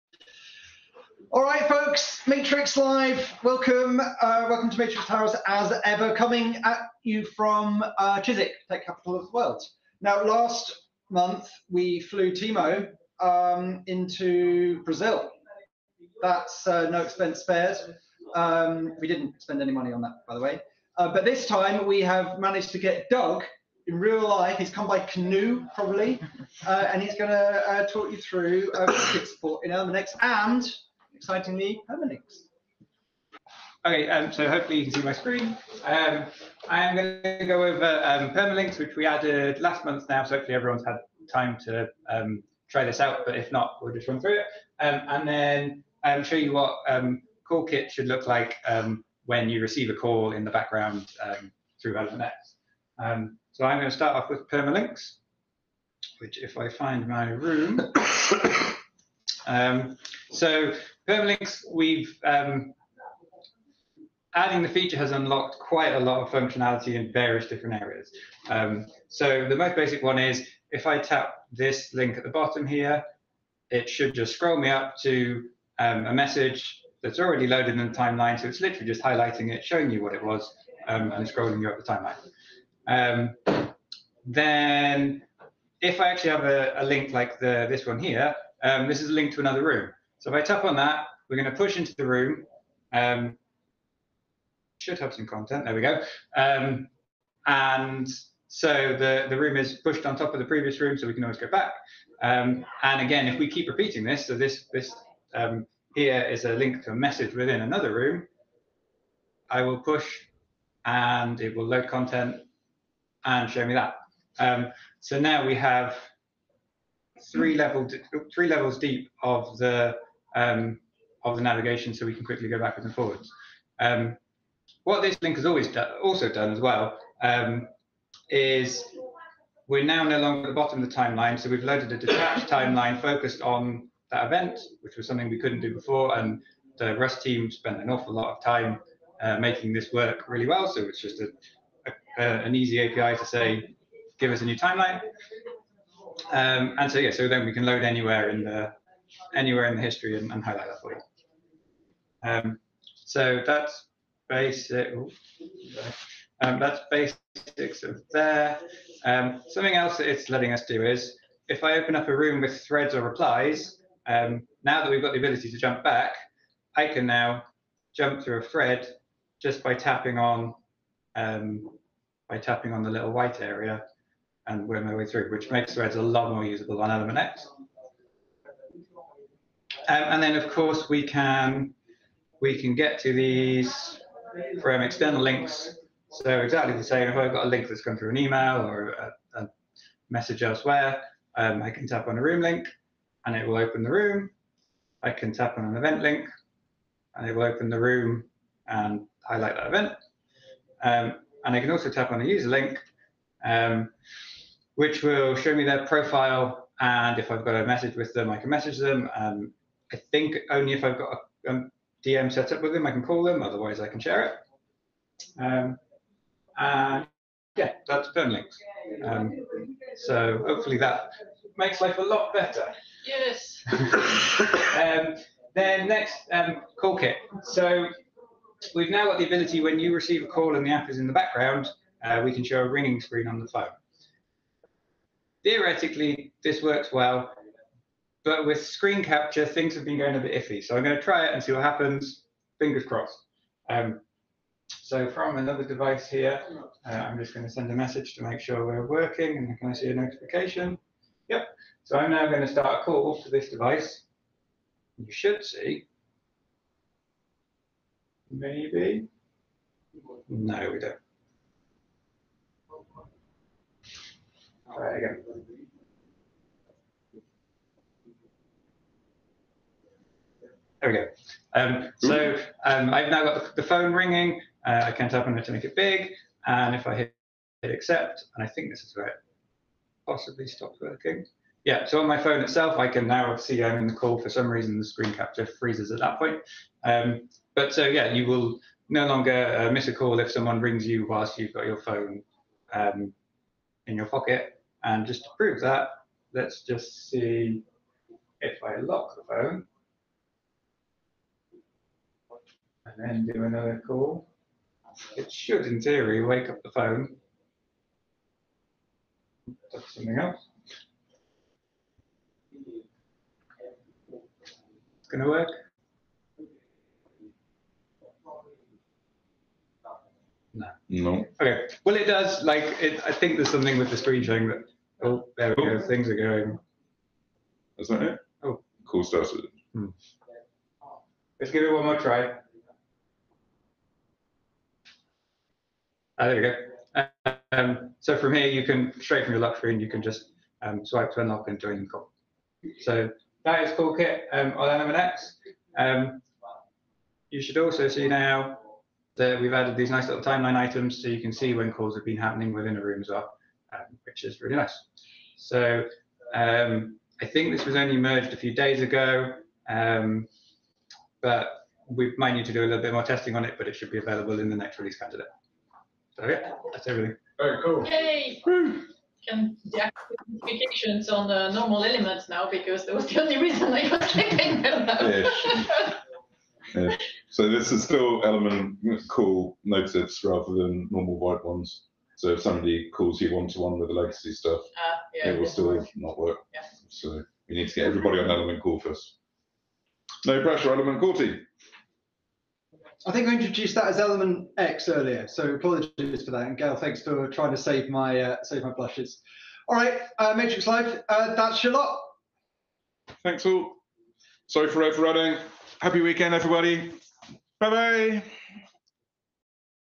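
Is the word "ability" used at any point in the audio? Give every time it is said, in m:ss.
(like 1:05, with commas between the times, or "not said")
2:45, 3:49.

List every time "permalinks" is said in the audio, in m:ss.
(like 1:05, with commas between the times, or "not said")
0:31, 0:38, 0:54, 1:01, 3:38.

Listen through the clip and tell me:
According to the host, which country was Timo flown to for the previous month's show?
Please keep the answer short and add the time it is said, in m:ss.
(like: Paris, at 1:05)
Brazil, at 0:14.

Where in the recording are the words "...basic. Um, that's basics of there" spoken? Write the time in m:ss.
2:34.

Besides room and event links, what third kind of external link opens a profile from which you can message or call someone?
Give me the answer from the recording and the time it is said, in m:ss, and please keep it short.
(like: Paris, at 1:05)
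a user link, at 3:22.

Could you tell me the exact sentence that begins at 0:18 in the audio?
Um, we didn't spend any money on that, by the way.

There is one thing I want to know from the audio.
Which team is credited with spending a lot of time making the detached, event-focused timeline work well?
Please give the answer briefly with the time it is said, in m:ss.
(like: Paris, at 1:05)
the Rust team, at 2:16.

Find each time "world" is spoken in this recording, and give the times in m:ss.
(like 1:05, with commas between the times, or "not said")
0:09.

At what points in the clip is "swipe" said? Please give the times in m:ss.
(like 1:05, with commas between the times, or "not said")
5:40.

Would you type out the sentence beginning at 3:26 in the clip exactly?
And if I've got a message with them, I can message them.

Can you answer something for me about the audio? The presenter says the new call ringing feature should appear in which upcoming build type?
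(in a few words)
next release candidate.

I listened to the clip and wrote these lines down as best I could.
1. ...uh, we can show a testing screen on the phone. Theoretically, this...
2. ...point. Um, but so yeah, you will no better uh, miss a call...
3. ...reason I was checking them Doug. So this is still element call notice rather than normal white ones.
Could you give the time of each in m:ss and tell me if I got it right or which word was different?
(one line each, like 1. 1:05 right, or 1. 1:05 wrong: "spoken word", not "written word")
1. 3:52 wrong: "ringing", not "testing"
2. 4:46 wrong: "longer", not "better"
3. 6:13 wrong: "Yeah", not "Doug".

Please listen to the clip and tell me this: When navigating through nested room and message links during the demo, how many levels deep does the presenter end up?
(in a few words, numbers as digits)
3.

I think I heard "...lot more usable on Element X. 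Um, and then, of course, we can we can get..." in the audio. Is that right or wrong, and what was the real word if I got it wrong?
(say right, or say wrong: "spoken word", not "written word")
right.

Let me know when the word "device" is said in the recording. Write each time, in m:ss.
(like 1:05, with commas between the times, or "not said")
4:05, 4:13.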